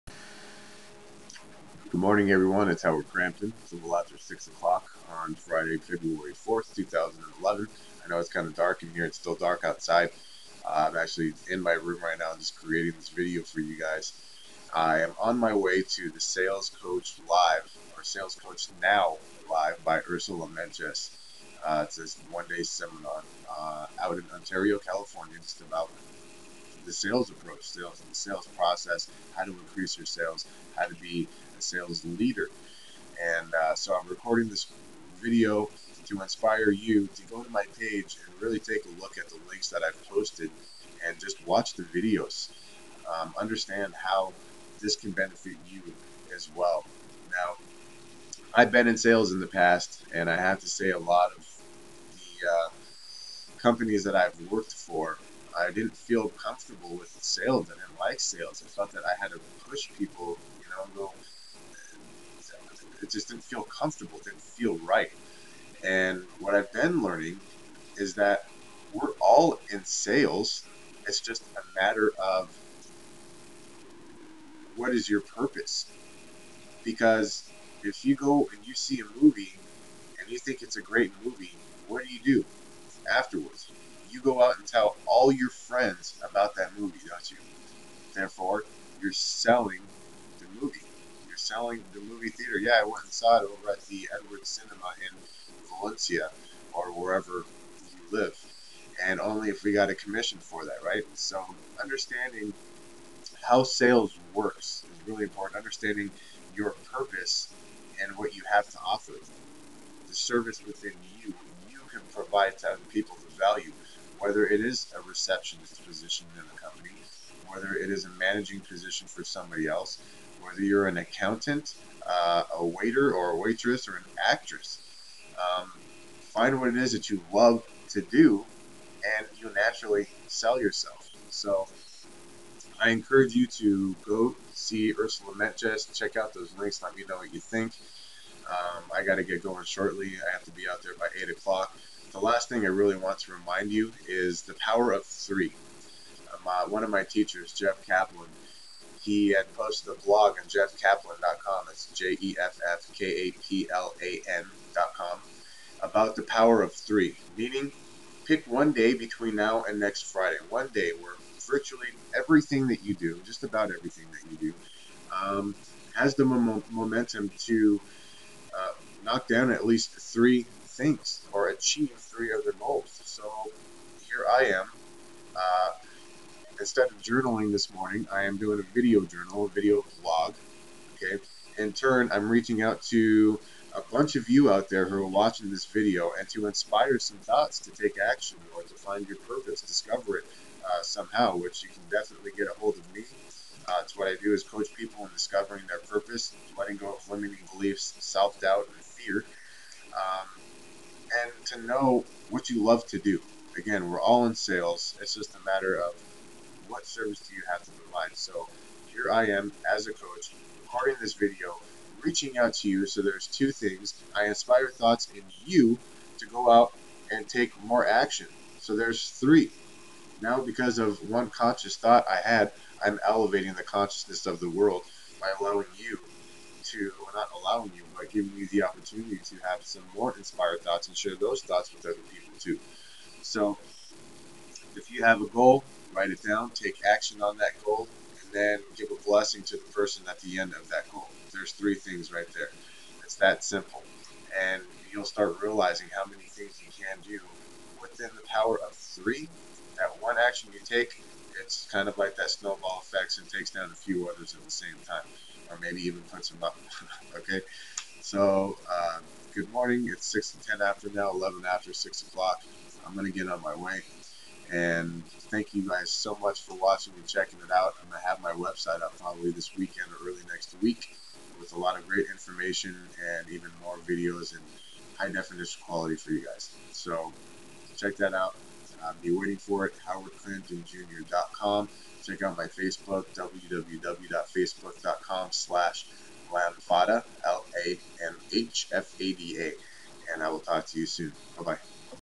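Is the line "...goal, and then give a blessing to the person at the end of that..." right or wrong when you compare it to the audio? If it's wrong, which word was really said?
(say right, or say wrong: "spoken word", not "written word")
right.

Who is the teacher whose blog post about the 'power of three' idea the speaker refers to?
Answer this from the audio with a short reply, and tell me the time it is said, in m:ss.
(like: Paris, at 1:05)
Jeff Kaplan, at 2:27.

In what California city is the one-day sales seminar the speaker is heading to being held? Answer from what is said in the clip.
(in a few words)
Ontario.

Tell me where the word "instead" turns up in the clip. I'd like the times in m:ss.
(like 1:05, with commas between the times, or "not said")
2:56.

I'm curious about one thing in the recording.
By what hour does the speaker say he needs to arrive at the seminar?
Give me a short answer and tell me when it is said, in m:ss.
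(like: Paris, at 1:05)
8 o'clock, at 2:21.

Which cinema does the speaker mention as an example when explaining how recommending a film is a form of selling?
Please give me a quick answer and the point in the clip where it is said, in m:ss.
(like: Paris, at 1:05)
Edwards Cinema, at 1:34.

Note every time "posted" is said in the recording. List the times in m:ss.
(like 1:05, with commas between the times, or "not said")
0:40, 2:29.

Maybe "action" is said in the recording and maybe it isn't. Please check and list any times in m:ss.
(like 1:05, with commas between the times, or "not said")
3:08, 3:37, 3:56, 4:10.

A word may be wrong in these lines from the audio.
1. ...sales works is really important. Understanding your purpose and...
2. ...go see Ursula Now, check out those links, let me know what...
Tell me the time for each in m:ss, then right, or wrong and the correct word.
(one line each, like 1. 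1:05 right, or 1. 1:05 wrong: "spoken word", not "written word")
1. 1:43 right
2. 2:14 wrong: "Mentjes", not "Now".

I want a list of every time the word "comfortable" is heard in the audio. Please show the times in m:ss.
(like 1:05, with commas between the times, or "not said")
0:56, 1:03.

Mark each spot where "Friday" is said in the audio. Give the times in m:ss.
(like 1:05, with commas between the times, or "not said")
0:05, 2:40.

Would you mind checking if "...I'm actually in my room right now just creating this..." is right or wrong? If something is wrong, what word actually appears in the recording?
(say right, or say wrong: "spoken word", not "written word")
right.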